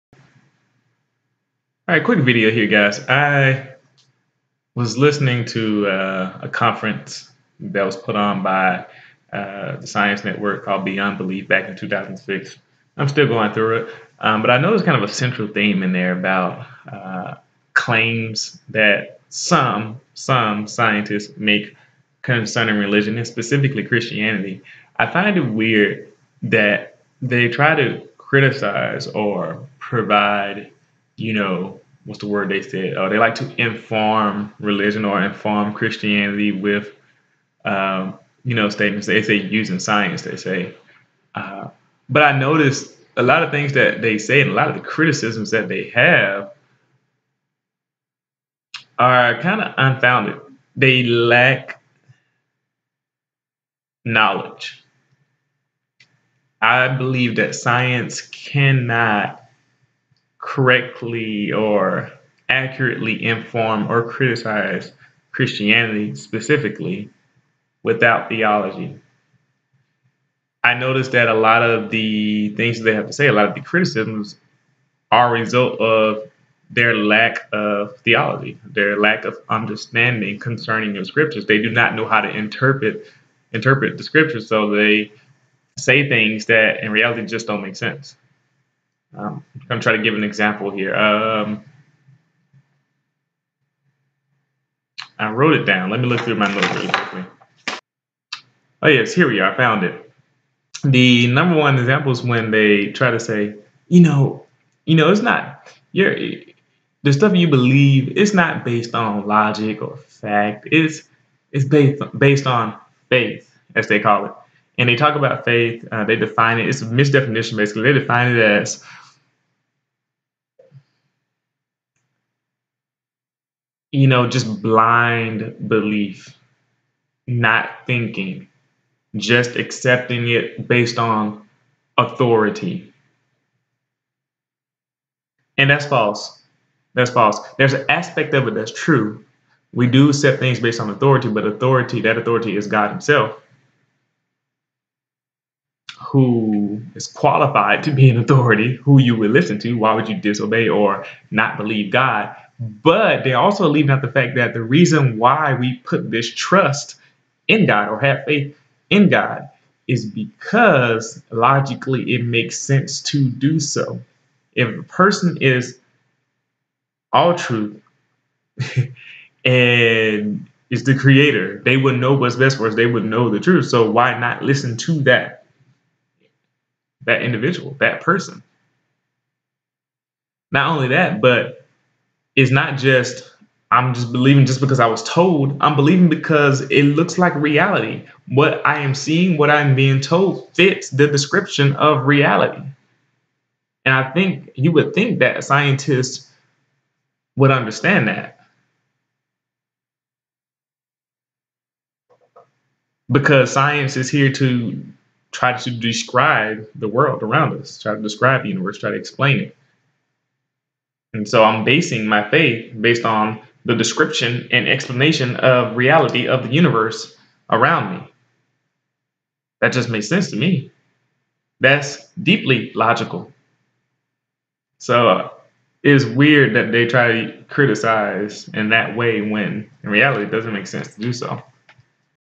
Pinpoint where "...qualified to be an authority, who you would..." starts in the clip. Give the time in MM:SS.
02:27.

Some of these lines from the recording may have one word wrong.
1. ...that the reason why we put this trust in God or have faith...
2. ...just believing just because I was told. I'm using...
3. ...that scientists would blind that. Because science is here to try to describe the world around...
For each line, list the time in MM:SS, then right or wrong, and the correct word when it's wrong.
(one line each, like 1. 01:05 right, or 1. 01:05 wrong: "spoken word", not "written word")
1. 02:34 right
2. 03:03 wrong: "believing", not "using"
3. 03:15 wrong: "understand", not "blind".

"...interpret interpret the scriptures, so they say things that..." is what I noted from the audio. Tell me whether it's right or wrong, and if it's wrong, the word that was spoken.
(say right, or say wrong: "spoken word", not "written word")
right.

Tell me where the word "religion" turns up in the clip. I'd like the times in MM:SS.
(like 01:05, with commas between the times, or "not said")
00:22, 00:34.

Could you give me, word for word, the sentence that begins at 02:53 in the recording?
So why not listen to that?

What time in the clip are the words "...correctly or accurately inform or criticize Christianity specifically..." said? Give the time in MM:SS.
01:00.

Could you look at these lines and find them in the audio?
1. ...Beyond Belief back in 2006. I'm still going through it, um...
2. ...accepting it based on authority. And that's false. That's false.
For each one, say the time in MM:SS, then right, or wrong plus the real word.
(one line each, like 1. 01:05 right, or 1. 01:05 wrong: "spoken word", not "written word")
1. 00:10 right
2. 02:09 right.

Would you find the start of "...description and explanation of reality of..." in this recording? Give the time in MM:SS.
03:33.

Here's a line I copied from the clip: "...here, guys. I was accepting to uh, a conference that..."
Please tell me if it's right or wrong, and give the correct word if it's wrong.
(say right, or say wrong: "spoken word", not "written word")
wrong: "listening", not "accepting".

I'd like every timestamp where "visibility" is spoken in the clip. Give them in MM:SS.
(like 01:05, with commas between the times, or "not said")
not said.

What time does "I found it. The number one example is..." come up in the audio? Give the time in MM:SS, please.
01:39.